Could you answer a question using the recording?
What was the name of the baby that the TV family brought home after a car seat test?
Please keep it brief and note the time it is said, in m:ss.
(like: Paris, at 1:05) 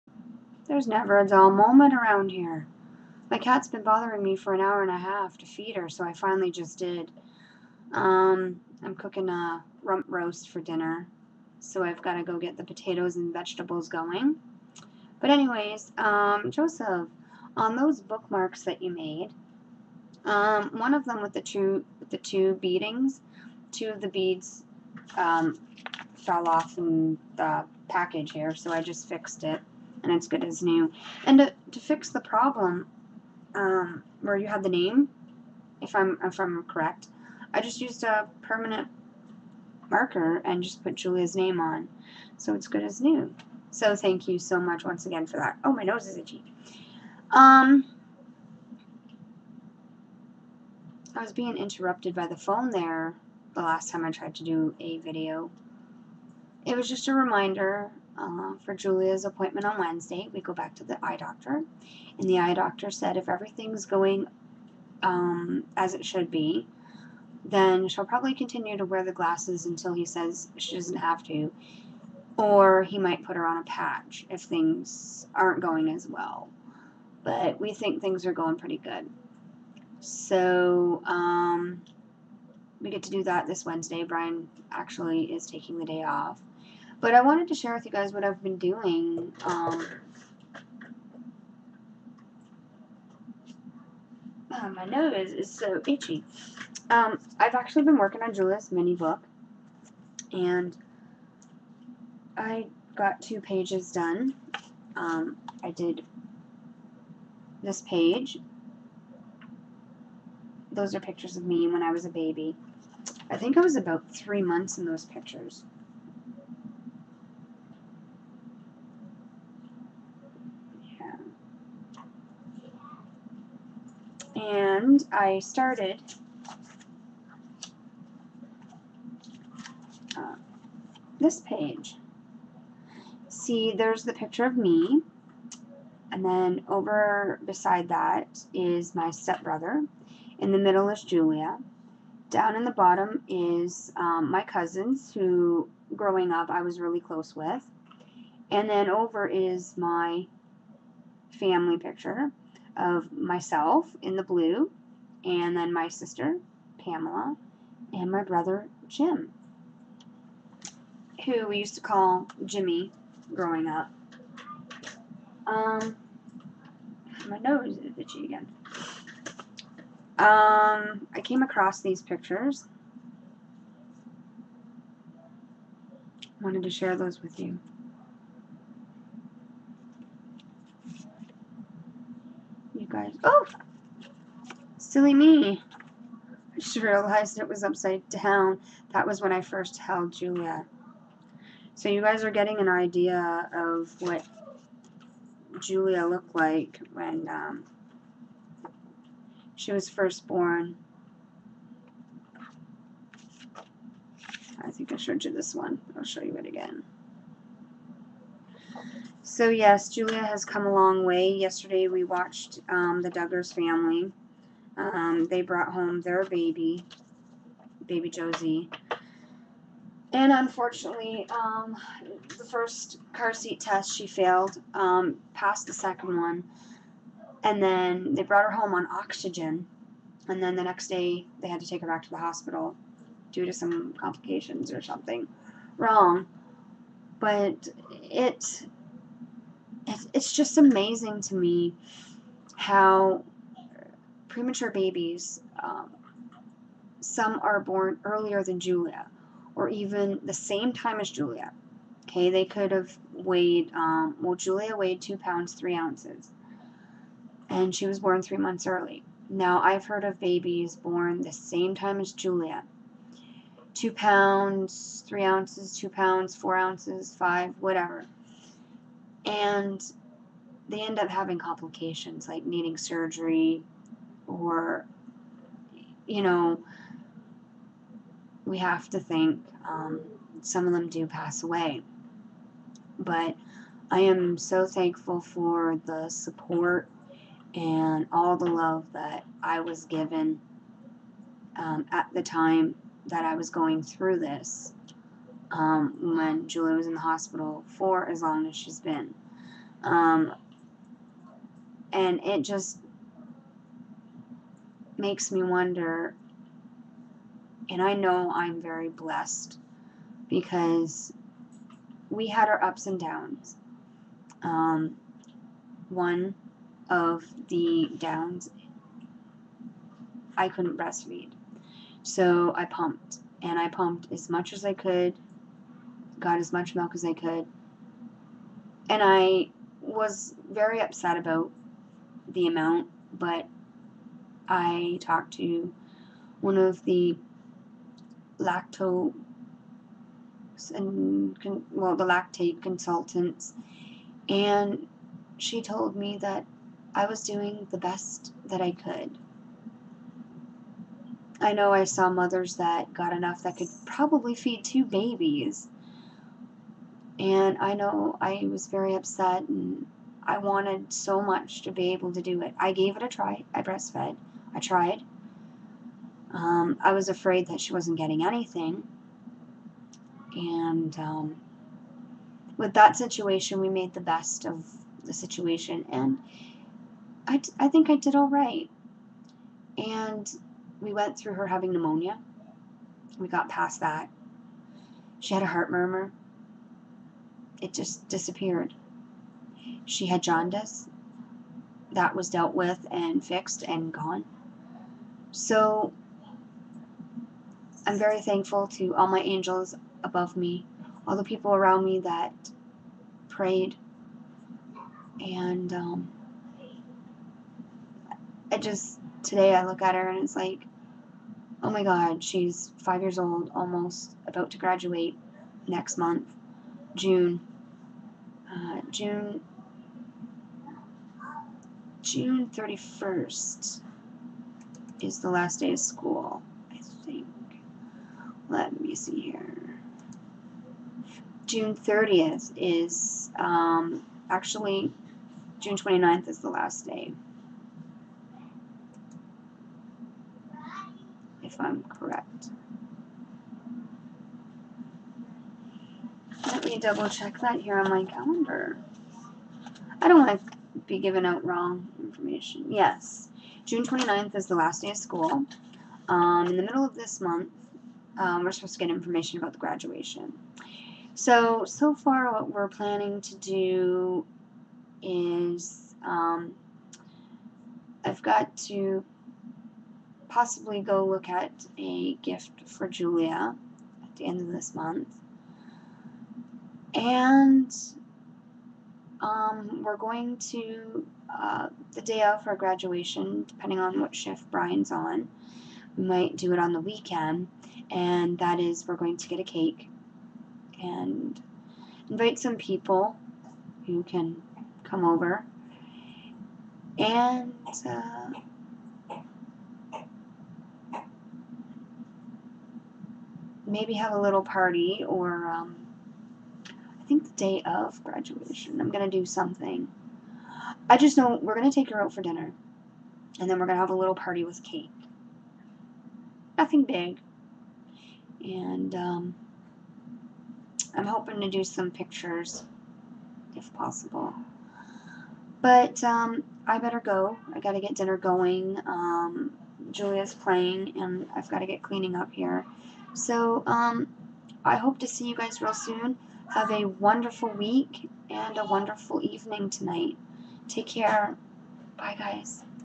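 Josie, at 3:38.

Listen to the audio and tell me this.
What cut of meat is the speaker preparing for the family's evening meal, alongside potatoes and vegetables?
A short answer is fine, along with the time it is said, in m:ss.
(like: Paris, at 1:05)
rump roast, at 0:09.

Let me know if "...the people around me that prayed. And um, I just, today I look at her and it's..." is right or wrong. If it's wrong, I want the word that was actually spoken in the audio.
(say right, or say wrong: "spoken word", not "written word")
right.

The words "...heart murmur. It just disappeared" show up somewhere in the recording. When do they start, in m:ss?
6:25.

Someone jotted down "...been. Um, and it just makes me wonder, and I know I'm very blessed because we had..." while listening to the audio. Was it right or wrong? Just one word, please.
right.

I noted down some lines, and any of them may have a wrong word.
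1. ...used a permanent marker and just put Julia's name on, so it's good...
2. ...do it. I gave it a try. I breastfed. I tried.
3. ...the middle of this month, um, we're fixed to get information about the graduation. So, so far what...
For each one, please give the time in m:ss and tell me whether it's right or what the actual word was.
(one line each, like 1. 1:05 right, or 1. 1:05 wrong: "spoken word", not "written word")
1. 0:37 right
2. 6:02 right
3. 7:36 wrong: "supposed", not "fixed".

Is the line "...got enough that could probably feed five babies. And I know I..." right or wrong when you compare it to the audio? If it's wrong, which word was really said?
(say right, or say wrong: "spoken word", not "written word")
wrong: "two", not "five".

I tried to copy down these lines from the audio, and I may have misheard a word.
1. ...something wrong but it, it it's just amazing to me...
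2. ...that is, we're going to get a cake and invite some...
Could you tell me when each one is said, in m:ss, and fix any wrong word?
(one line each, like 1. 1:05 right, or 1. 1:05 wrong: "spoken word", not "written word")
1. 3:54 right
2. 8:08 right.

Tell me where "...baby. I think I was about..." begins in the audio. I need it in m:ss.
1:52.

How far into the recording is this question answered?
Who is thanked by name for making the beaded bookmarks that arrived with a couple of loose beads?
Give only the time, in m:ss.
0:16.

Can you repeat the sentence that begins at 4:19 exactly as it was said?
Now, I've heard of babies born the same time as Julia two pounds, three ounces, two pounds, four ounces, five, whatever.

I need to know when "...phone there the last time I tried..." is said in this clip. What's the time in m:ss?
0:52.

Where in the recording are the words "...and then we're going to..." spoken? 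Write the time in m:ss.
8:33.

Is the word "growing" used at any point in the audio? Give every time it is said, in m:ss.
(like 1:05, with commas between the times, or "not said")
2:25, 2:43.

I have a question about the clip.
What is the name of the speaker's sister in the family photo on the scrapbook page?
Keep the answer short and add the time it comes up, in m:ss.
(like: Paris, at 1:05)
Pamela, at 2:36.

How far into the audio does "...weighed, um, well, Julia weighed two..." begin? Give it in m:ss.
4:13.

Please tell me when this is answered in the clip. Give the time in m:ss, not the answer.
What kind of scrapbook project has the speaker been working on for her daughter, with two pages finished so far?
1:38.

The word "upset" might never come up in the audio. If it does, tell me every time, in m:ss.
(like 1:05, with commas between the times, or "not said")
5:30, 5:58.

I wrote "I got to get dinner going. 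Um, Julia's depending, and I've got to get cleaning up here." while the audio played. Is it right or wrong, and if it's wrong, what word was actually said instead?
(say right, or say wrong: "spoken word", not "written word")
wrong: "playing", not "depending".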